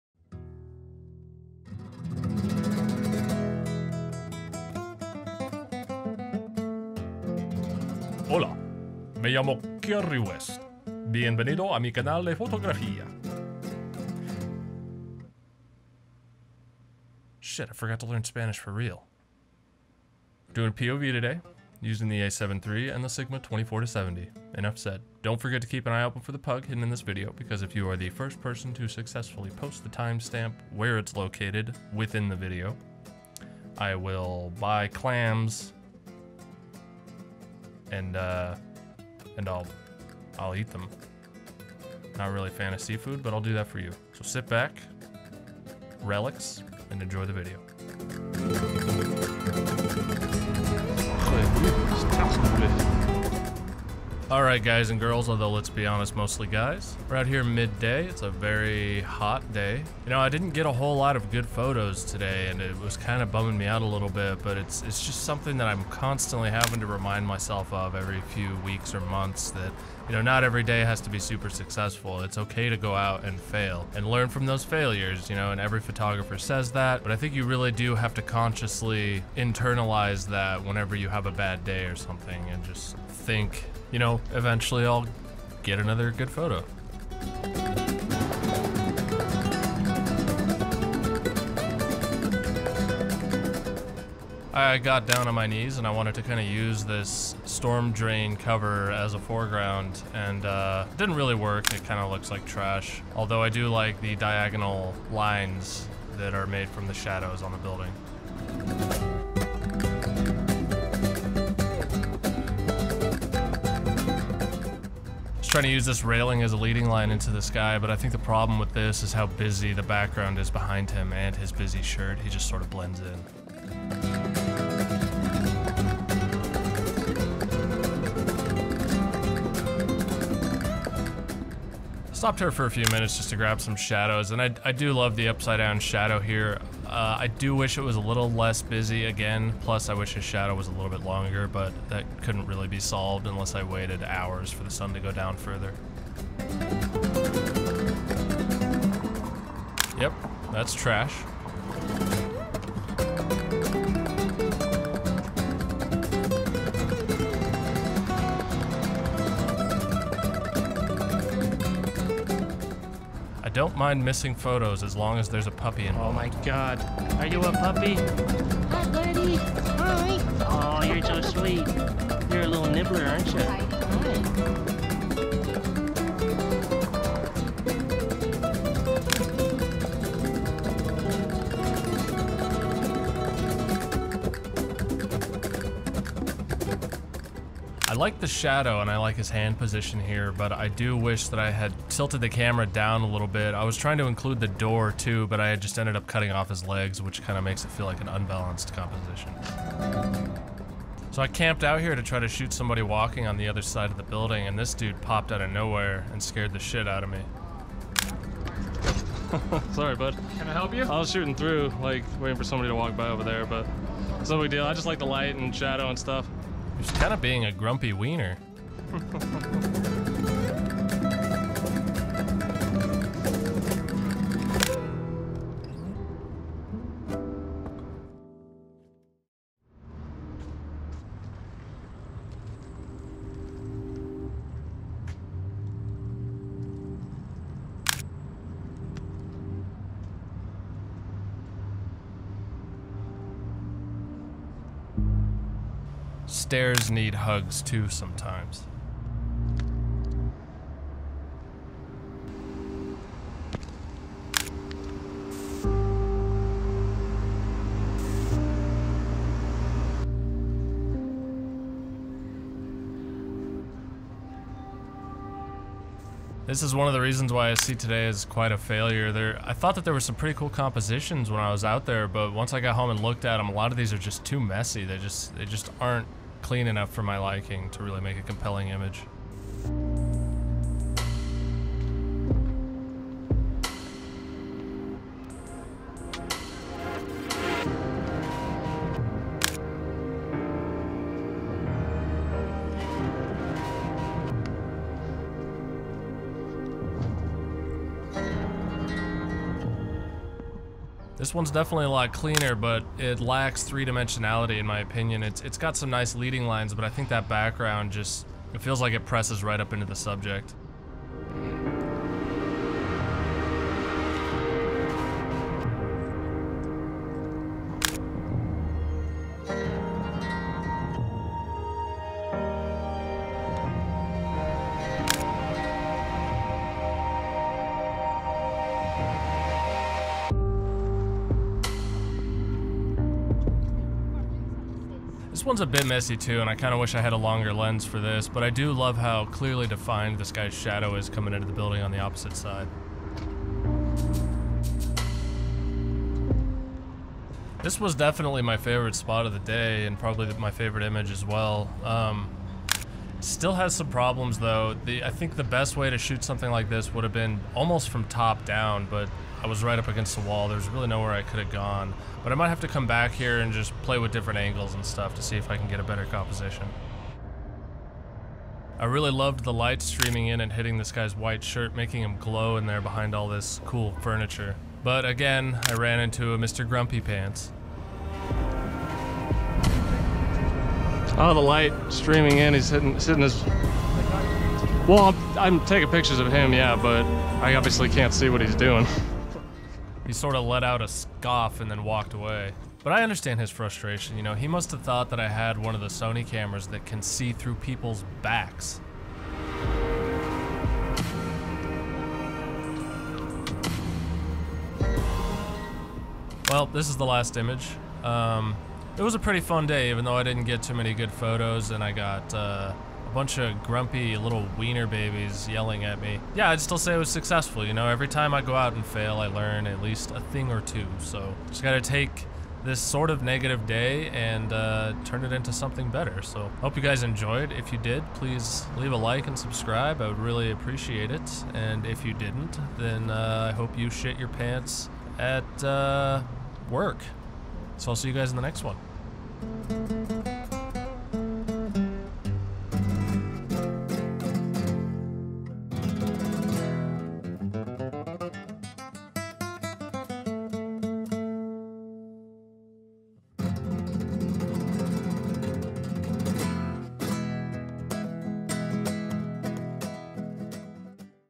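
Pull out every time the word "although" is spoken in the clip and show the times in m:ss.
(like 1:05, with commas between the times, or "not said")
0:55, 1:43.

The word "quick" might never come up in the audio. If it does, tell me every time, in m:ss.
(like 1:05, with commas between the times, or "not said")
not said.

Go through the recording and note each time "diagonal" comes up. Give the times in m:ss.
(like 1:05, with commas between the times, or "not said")
1:44.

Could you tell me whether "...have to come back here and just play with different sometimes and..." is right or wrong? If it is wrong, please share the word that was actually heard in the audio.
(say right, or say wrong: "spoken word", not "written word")
wrong: "angles", not "sometimes".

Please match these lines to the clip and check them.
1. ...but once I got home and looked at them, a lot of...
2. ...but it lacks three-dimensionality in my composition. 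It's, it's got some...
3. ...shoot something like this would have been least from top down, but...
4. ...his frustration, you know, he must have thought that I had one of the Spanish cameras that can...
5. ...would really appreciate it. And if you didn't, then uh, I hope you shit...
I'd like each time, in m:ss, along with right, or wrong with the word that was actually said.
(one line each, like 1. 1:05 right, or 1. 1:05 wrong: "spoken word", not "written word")
1. 4:32 right
2. 5:02 wrong: "opinion", not "composition"
3. 5:55 wrong: "almost", not "least"
4. 6:33 wrong: "Sony", not "Spanish"
5. 7:10 right.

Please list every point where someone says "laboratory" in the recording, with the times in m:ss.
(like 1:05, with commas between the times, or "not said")
not said.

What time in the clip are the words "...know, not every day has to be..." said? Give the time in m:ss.
1:10.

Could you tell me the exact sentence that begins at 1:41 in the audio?
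It kind of looks like trash.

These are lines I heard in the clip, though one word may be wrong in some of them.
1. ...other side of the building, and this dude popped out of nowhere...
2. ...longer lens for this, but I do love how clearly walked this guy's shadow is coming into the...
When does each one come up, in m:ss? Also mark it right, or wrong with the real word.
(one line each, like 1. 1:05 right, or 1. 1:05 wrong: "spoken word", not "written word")
1. 3:23 right
2. 5:37 wrong: "defined", not "walked".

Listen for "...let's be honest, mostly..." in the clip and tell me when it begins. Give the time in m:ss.
0:55.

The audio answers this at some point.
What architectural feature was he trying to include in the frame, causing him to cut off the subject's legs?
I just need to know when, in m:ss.
3:14.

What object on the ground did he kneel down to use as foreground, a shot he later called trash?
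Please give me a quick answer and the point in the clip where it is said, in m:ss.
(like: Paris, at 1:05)
Storm drain cover, at 1:37.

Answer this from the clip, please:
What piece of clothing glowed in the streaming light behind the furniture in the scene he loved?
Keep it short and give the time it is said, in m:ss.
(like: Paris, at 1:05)
White shirt, at 6:11.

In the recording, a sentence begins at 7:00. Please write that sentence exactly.
So just gotta take this sort of negative day and uh, turn it into something better.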